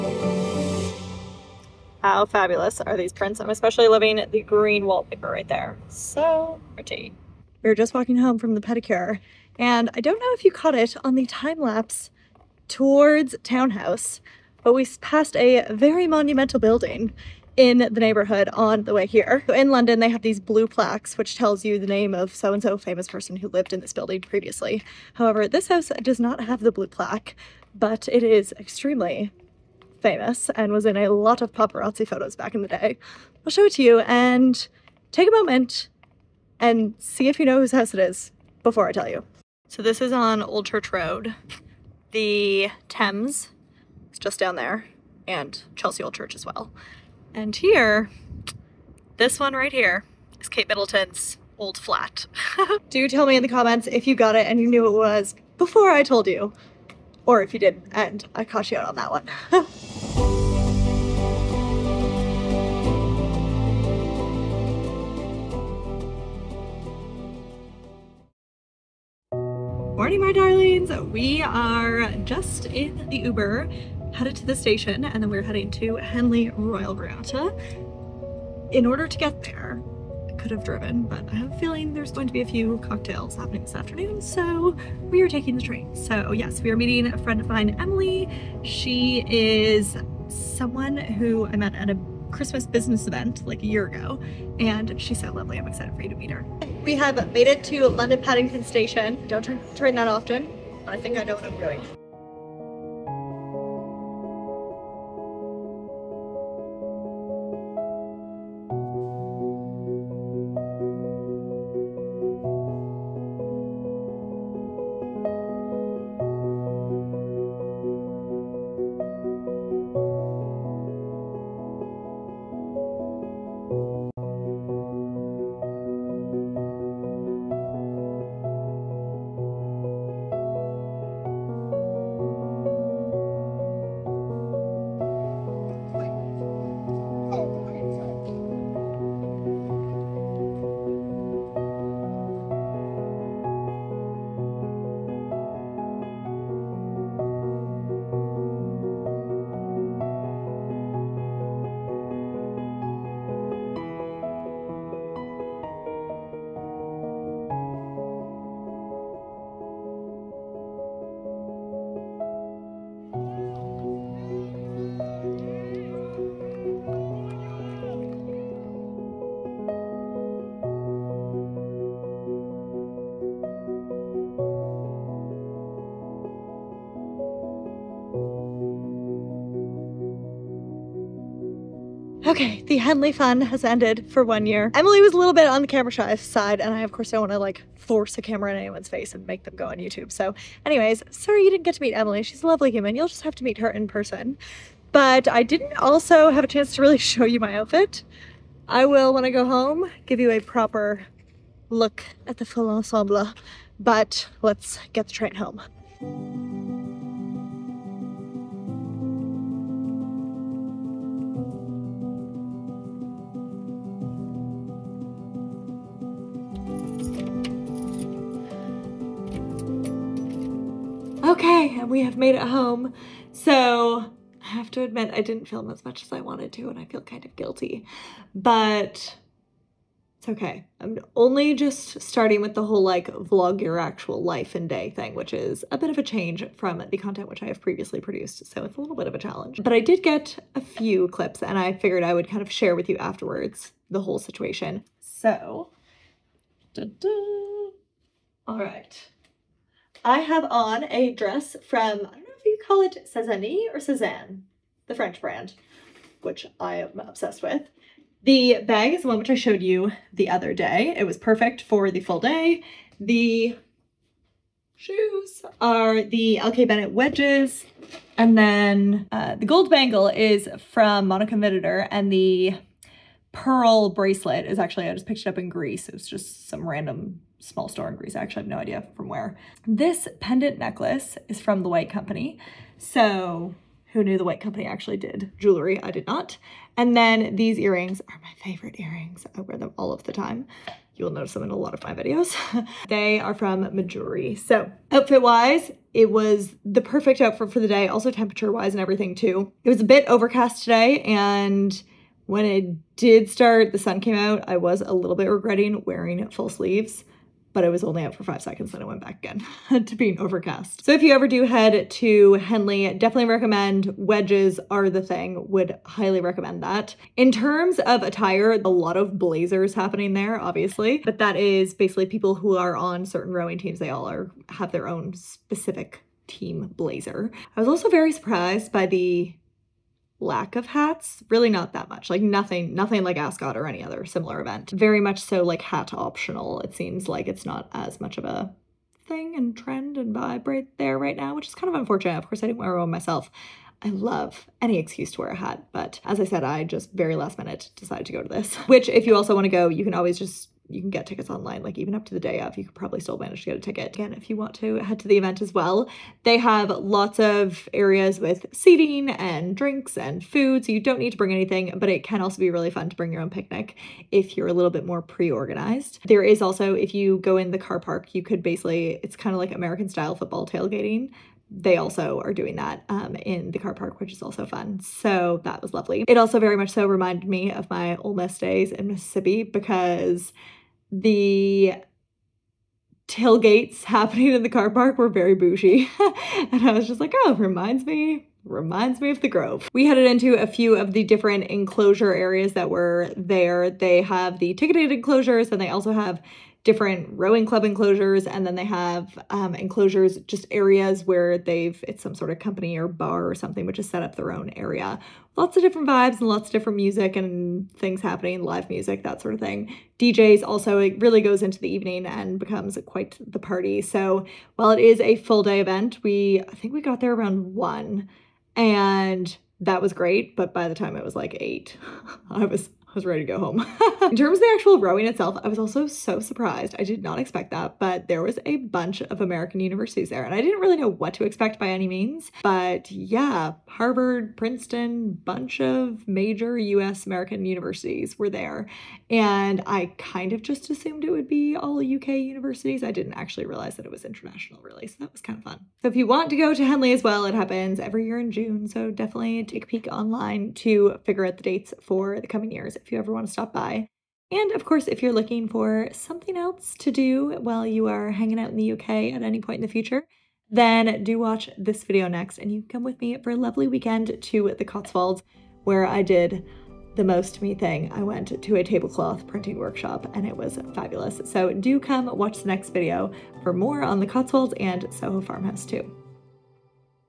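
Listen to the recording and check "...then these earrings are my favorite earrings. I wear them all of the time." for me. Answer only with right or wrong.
right.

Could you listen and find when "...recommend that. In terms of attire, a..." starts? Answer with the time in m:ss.
5:16.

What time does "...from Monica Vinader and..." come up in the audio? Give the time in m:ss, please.
4:30.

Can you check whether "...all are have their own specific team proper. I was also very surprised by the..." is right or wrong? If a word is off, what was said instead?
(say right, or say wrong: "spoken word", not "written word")
wrong: "blazer", not "proper".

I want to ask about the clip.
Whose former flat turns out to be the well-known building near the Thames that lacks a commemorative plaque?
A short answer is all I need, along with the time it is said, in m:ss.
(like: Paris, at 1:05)
Kate Middleton, at 0:50.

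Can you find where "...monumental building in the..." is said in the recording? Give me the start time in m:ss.
0:16.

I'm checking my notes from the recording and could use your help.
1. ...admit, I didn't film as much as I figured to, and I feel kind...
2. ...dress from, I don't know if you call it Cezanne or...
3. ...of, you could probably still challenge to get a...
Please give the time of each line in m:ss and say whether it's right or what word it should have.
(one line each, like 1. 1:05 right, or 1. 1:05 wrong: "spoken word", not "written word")
1. 3:44 wrong: "wanted", not "figured"
2. 4:11 right
3. 5:52 wrong: "manage", not "challenge".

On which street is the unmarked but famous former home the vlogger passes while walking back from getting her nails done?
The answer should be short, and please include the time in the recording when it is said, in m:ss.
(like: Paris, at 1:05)
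Old Church Road, at 0:40.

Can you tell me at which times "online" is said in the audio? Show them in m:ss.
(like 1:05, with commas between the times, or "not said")
5:51, 7:29.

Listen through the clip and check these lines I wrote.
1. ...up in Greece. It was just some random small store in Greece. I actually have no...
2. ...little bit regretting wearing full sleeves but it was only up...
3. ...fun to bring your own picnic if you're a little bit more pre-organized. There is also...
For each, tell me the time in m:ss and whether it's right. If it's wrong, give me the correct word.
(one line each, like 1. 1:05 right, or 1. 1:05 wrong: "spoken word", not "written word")
1. 4:35 right
2. 5:04 right
3. 6:02 right.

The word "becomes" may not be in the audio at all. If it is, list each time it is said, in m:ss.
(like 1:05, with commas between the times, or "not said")
6:52.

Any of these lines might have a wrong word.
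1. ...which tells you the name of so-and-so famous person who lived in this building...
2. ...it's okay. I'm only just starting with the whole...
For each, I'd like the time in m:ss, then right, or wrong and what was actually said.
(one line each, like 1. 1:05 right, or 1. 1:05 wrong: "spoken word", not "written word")
1. 0:21 right
2. 3:50 right.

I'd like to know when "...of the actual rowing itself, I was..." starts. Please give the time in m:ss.
7:04.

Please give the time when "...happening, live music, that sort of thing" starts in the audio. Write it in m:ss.
6:48.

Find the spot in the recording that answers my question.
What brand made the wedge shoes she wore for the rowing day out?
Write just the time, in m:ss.
4:26.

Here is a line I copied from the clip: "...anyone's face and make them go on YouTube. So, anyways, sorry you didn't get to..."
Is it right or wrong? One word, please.
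right.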